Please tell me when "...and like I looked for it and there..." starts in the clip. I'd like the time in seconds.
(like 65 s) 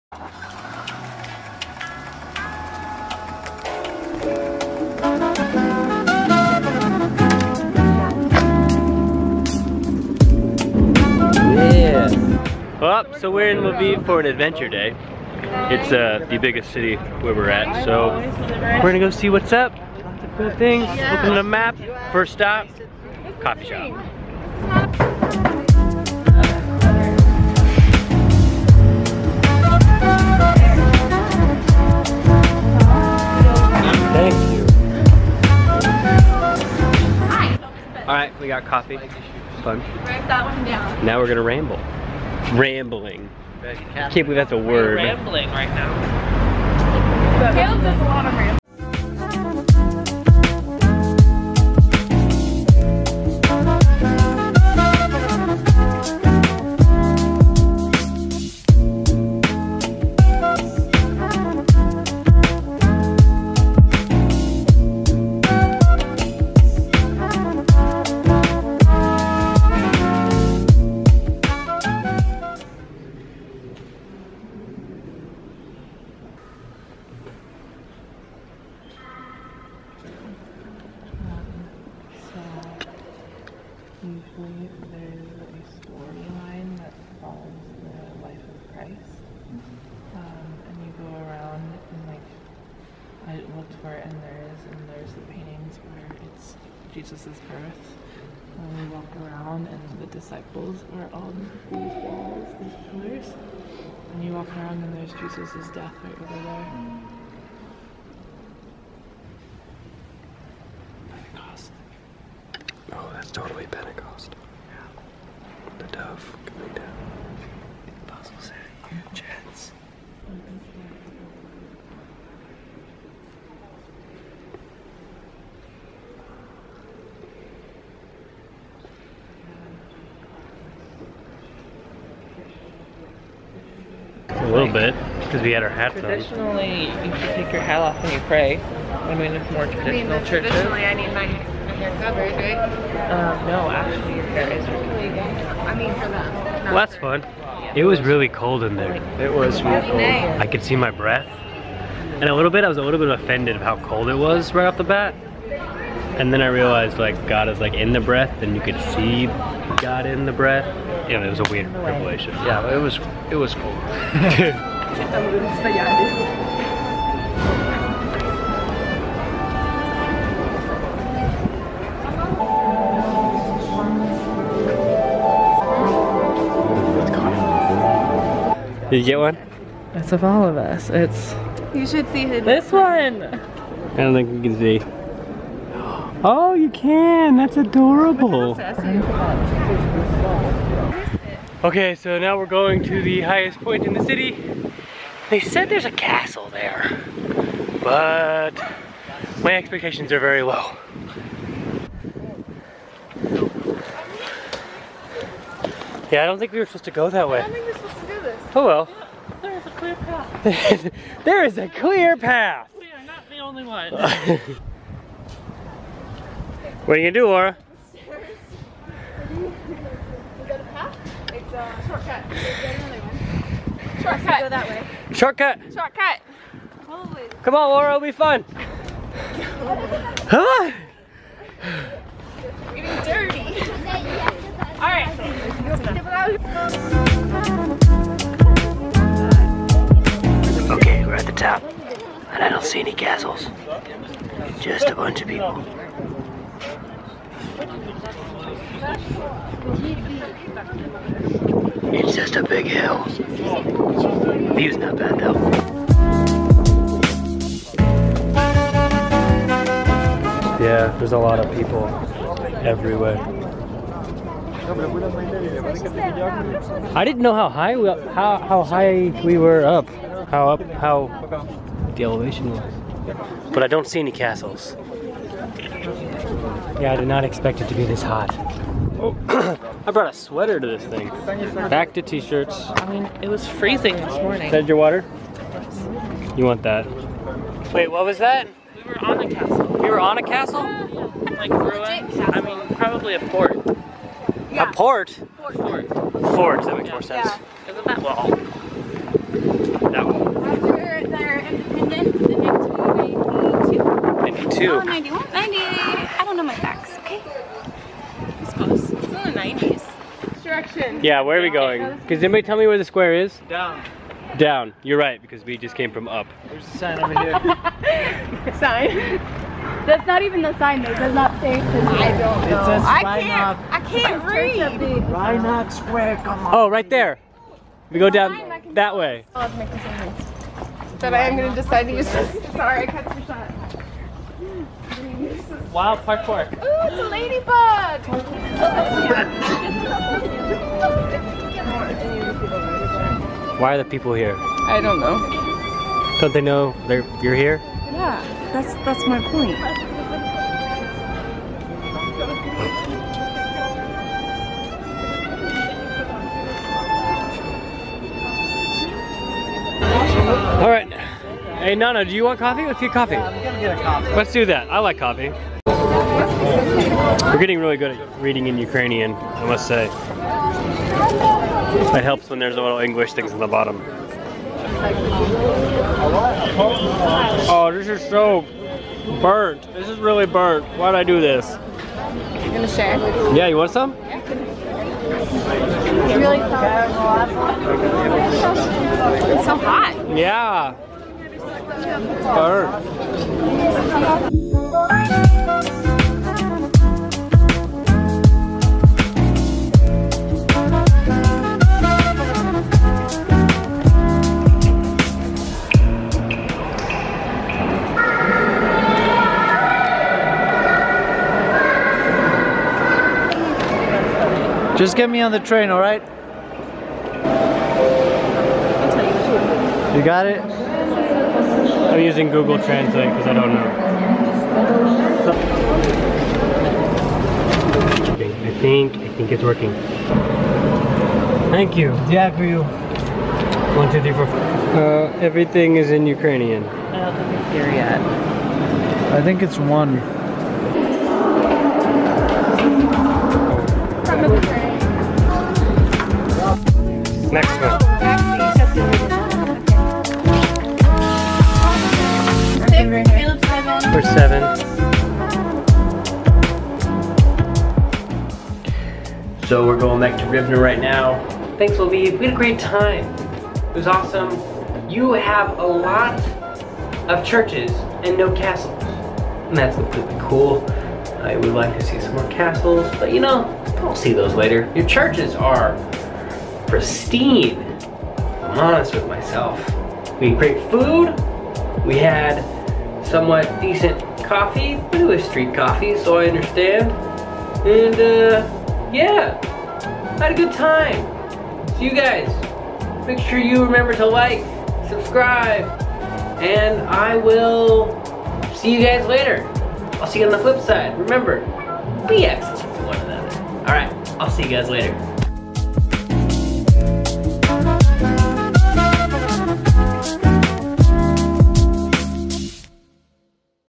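91 s.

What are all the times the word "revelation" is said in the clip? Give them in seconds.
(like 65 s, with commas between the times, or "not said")
161 s.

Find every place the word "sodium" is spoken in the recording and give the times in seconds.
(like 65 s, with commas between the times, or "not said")
not said.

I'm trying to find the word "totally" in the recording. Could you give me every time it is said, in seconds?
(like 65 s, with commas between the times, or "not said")
113 s.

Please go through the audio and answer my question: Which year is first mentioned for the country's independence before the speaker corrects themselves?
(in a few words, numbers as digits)
1992.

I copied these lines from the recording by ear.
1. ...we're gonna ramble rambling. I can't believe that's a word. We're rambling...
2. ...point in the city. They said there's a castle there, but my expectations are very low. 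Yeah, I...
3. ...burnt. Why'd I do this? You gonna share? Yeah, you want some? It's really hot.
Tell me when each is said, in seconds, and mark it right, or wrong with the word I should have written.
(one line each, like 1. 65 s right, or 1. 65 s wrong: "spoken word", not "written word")
1. 41 s right
2. 193 s right
3. 380 s right.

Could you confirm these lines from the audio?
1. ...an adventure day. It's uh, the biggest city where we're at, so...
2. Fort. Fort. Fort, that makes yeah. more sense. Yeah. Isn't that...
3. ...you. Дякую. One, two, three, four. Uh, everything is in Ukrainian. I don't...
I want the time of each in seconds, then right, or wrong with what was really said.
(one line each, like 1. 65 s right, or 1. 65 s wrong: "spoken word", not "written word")
1. 14 s right
2. 295 s right
3. 431 s right.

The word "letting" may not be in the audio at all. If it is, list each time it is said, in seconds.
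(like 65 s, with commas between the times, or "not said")
not said.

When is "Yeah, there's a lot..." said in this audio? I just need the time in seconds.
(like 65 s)
260 s.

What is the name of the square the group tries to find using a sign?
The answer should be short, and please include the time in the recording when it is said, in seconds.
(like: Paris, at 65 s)
Rynok Square, at 325 s.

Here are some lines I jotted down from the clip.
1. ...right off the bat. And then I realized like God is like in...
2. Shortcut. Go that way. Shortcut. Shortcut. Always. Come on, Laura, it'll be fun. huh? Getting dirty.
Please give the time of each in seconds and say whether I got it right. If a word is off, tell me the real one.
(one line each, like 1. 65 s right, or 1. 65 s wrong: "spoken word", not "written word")
1. 154 s right
2. 224 s right.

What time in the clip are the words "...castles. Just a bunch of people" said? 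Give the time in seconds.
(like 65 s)
242 s.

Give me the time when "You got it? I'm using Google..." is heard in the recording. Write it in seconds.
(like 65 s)
419 s.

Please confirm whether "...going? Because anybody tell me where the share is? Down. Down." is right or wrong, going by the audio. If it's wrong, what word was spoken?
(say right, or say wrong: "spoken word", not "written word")
wrong: "square", not "share".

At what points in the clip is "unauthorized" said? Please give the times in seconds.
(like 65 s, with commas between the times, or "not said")
not said.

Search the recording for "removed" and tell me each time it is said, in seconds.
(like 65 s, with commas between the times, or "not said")
not said.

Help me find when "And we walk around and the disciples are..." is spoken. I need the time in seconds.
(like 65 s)
98 s.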